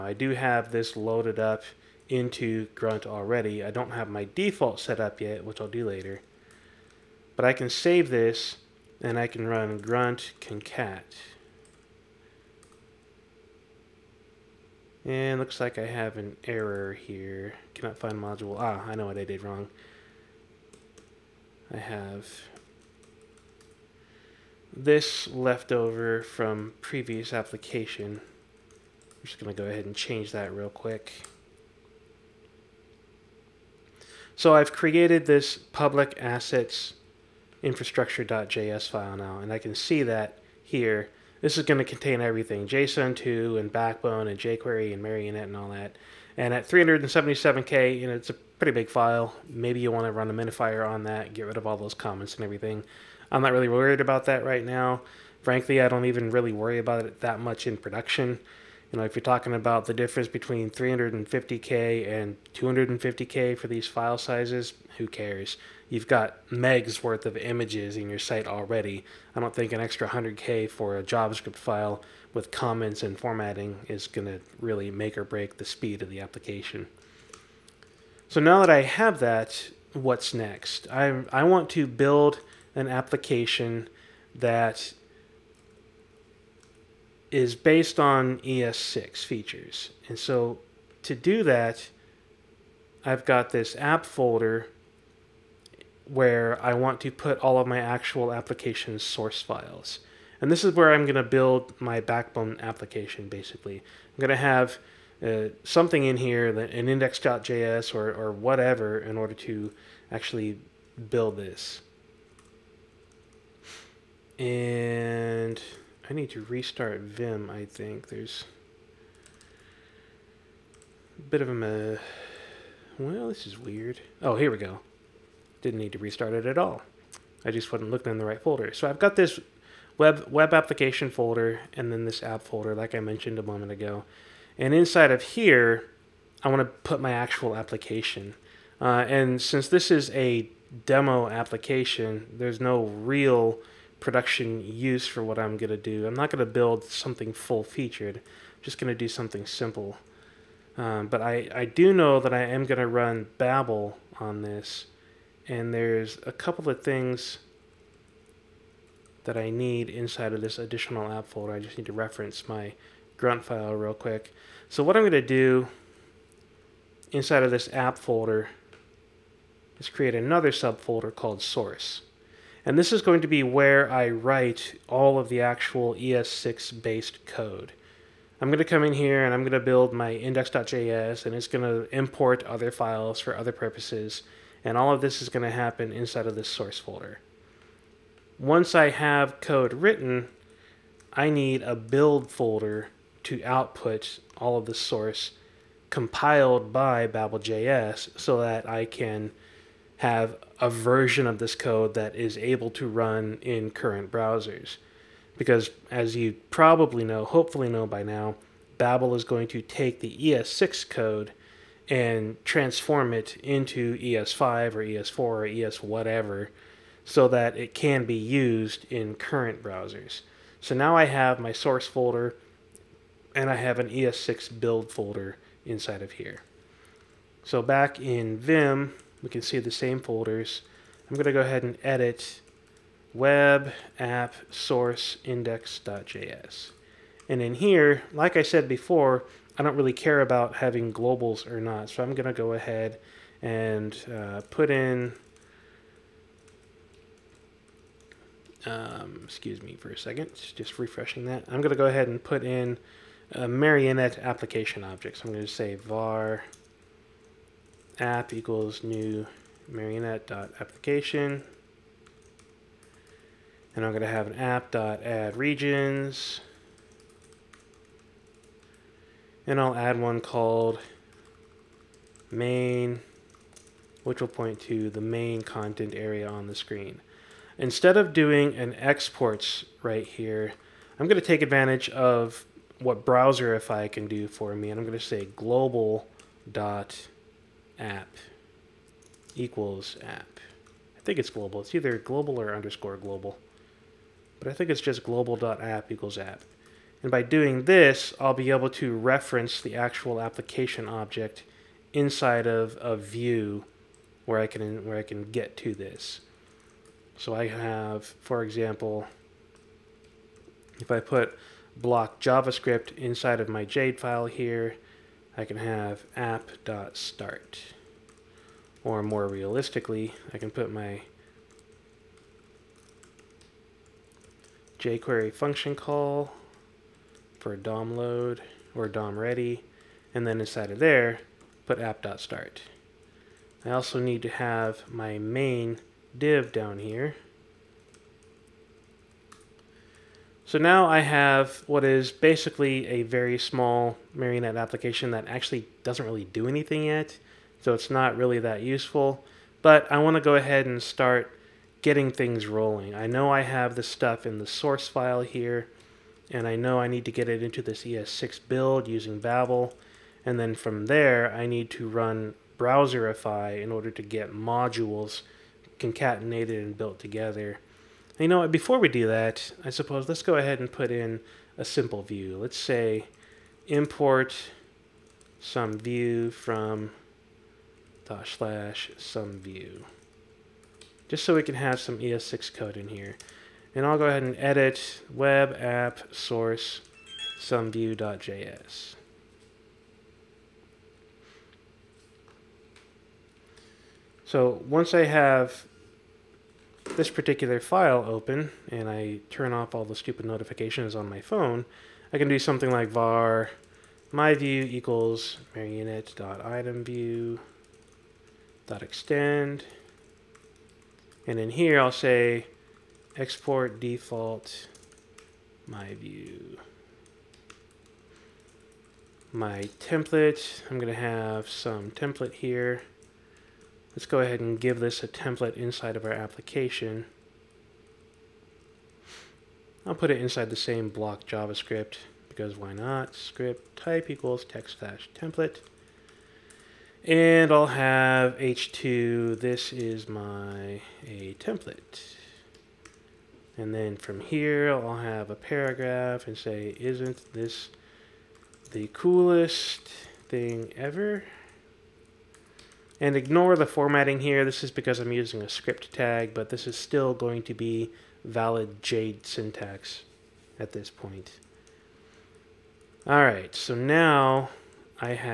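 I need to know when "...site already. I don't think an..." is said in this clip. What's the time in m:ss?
1:08.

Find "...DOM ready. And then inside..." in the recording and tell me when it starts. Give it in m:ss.
5:28.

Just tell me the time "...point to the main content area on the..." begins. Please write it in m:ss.
4:34.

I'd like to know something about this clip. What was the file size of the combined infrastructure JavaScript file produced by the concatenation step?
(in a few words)
377K.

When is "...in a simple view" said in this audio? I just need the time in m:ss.
6:10.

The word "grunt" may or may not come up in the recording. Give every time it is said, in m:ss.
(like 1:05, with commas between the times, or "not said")
0:02, 0:09, 2:43.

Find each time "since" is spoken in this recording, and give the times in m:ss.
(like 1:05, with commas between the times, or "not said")
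2:19.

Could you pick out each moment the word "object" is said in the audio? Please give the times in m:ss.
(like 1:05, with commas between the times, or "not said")
4:14, 5:00.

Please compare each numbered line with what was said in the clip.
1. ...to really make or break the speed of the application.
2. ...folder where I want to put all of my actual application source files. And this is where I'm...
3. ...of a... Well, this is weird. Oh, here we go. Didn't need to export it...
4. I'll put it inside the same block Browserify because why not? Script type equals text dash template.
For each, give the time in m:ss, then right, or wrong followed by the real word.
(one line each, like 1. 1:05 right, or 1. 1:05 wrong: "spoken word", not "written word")
1. 1:14 right
2. 1:34 right
3. 2:01 wrong: "restart", not "export"
4. 7:09 wrong: "JavaScript", not "Browserify".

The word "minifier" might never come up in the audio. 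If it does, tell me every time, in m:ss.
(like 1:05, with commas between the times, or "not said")
0:50.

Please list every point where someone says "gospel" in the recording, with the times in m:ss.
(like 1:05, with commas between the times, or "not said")
not said.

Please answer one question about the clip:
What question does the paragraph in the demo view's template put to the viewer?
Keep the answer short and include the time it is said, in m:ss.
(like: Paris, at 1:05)
Isn't this the coolest thing ever?, at 7:26.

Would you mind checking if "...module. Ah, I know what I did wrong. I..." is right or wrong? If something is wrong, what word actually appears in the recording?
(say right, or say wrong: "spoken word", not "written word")
right.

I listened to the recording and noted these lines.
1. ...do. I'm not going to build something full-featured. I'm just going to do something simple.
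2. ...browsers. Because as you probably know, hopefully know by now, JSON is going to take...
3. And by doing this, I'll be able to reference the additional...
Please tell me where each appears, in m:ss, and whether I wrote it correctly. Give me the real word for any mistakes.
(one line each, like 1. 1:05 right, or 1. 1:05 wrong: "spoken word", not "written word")
1. 2:25 right
2. 3:24 wrong: "Babel", not "JSON"
3. 4:57 wrong: "actual", not "additional".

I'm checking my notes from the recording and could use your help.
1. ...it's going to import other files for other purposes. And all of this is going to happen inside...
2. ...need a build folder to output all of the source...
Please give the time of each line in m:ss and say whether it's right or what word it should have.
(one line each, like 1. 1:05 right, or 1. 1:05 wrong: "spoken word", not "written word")
1. 3:01 right
2. 3:11 right.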